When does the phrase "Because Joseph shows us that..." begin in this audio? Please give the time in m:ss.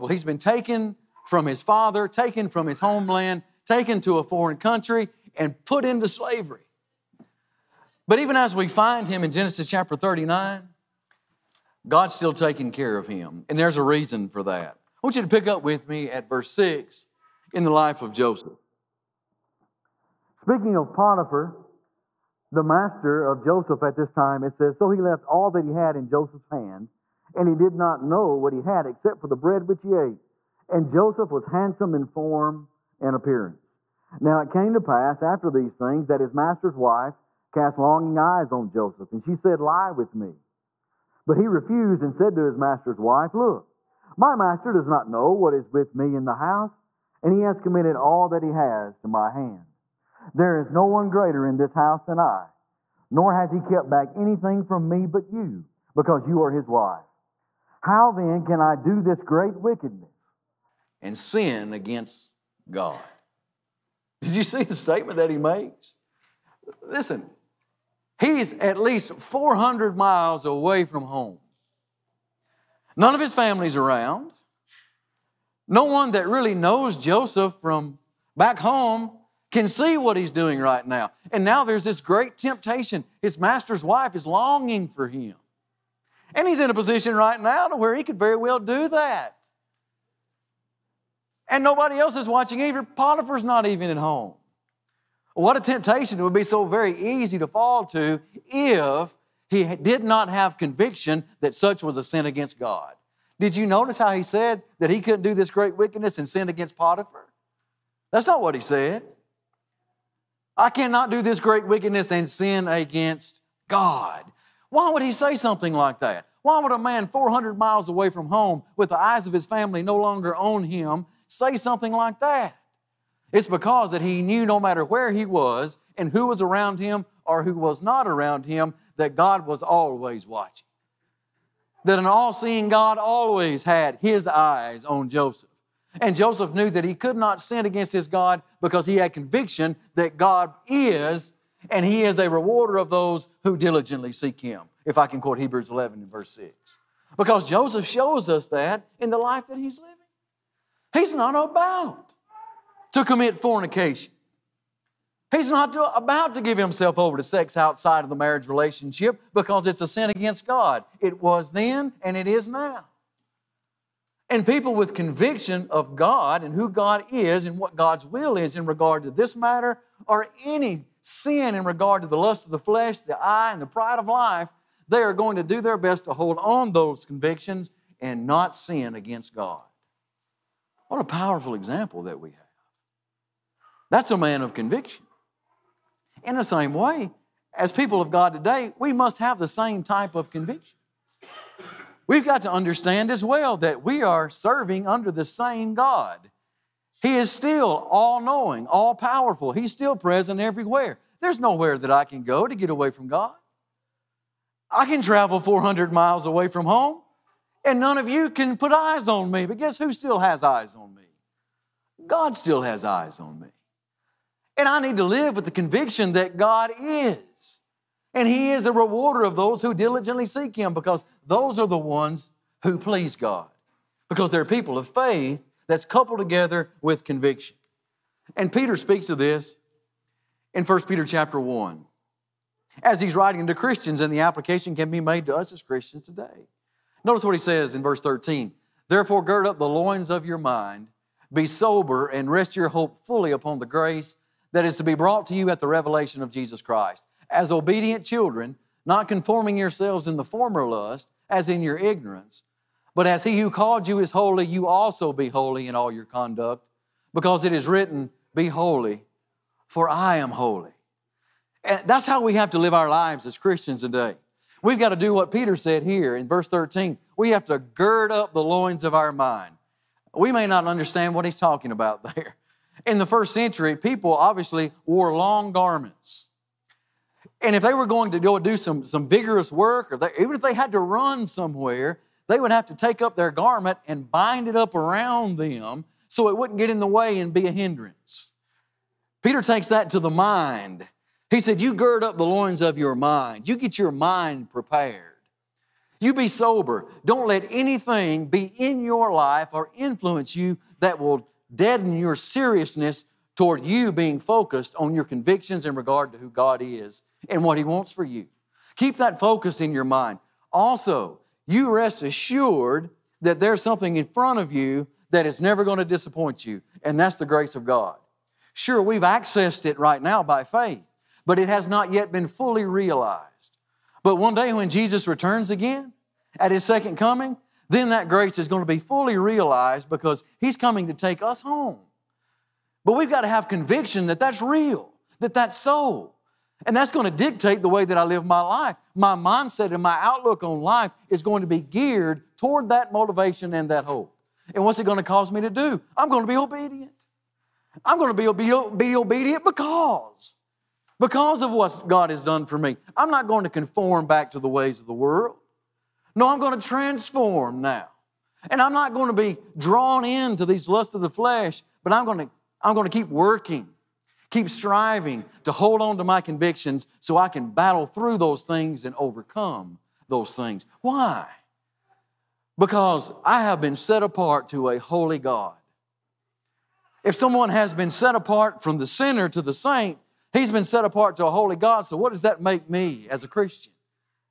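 2:27.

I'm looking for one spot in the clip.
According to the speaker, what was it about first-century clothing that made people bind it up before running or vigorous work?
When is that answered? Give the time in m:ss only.
4:35.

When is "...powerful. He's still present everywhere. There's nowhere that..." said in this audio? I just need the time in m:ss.
3:18.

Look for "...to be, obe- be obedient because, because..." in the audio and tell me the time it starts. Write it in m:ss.
5:48.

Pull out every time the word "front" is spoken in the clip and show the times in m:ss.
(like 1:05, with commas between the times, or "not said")
5:14.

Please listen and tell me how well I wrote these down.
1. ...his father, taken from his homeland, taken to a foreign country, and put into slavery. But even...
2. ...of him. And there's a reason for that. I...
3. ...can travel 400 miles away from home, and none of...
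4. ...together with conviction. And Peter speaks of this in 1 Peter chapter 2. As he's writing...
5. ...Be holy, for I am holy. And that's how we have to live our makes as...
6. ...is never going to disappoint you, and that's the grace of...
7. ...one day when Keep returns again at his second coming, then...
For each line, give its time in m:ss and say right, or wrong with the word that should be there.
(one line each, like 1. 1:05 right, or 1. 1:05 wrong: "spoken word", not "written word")
1. 0:01 right
2. 0:12 right
3. 3:24 right
4. 3:46 wrong: "1", not "2"
5. 4:18 wrong: "lives", not "makes"
6. 5:15 right
7. 5:24 wrong: "Jesus", not "Keep".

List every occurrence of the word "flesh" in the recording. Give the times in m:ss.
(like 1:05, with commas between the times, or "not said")
2:52, 6:01.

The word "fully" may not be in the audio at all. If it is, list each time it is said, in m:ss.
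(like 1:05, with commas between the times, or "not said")
4:03, 5:22, 5:28.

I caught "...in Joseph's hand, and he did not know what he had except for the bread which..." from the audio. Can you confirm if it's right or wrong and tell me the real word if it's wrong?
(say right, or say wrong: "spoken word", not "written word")
right.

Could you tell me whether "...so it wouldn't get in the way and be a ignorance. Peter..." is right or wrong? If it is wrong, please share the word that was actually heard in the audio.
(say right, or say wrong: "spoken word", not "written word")
wrong: "hindrance", not "ignorance".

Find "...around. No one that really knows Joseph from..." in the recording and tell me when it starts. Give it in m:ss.
1:13.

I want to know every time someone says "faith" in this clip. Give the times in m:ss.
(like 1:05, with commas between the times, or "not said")
3:44, 5:20.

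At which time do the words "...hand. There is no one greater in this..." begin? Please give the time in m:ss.
0:49.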